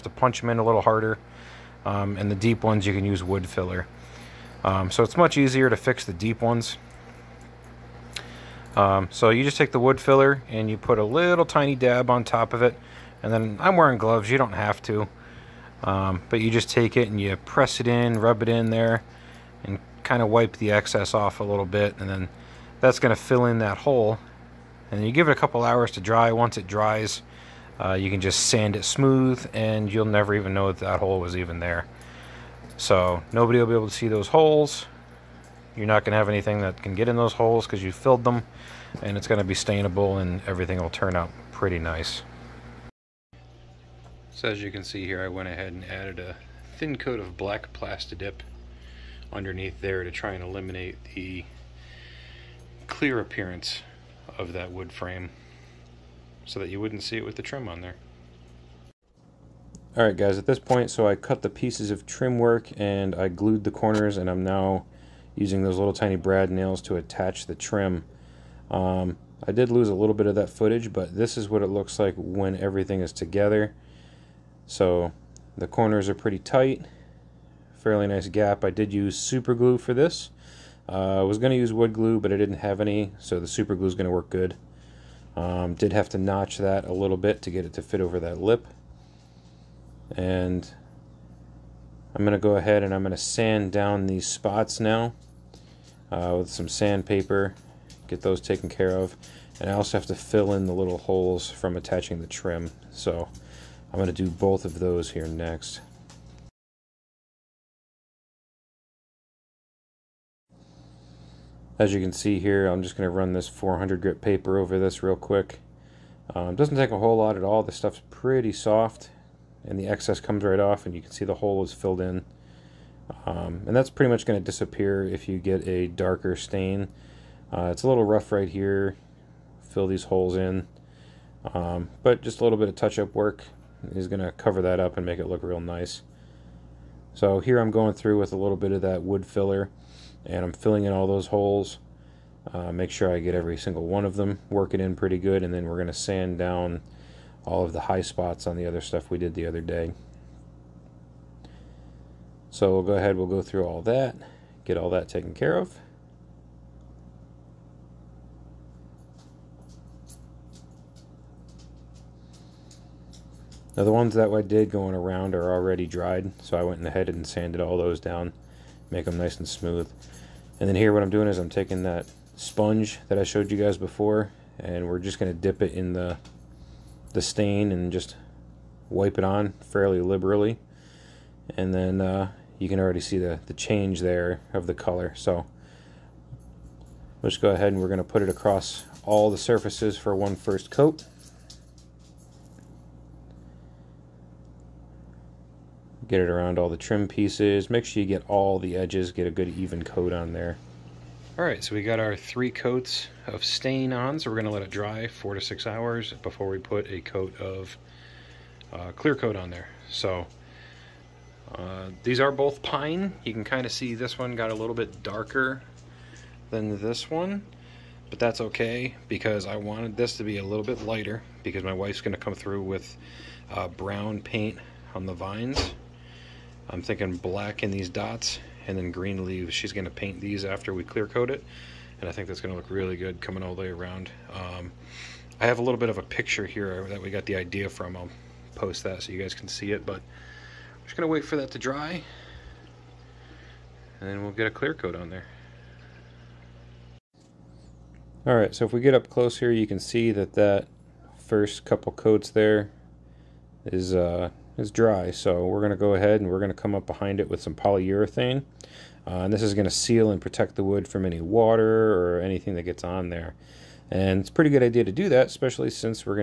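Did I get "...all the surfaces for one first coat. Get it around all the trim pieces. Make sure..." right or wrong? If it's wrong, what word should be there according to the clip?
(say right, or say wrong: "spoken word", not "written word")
right.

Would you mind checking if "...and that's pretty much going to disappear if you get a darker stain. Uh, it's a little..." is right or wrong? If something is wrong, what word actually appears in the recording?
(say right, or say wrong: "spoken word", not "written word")
right.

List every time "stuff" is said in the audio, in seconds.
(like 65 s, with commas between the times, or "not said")
117 s, 148 s.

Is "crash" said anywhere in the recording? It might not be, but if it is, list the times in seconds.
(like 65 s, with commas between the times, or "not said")
not said.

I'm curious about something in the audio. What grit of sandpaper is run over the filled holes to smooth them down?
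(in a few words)
400.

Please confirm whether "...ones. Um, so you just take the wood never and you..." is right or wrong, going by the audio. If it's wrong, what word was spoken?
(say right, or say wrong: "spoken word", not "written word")
wrong: "filler", not "never".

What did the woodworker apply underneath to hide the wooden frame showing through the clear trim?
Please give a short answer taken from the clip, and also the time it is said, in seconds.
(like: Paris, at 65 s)
black Plastidip, at 47 s.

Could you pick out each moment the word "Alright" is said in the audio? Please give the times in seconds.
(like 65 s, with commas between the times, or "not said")
59 s.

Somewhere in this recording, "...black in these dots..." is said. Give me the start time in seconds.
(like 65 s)
227 s.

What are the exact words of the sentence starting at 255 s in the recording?
So we're going to go ahead and we're going to come up behind it with some polyurethane.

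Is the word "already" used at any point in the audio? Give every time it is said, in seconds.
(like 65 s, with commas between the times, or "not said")
165 s, 182 s.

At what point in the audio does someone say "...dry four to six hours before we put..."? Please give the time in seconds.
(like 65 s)
204 s.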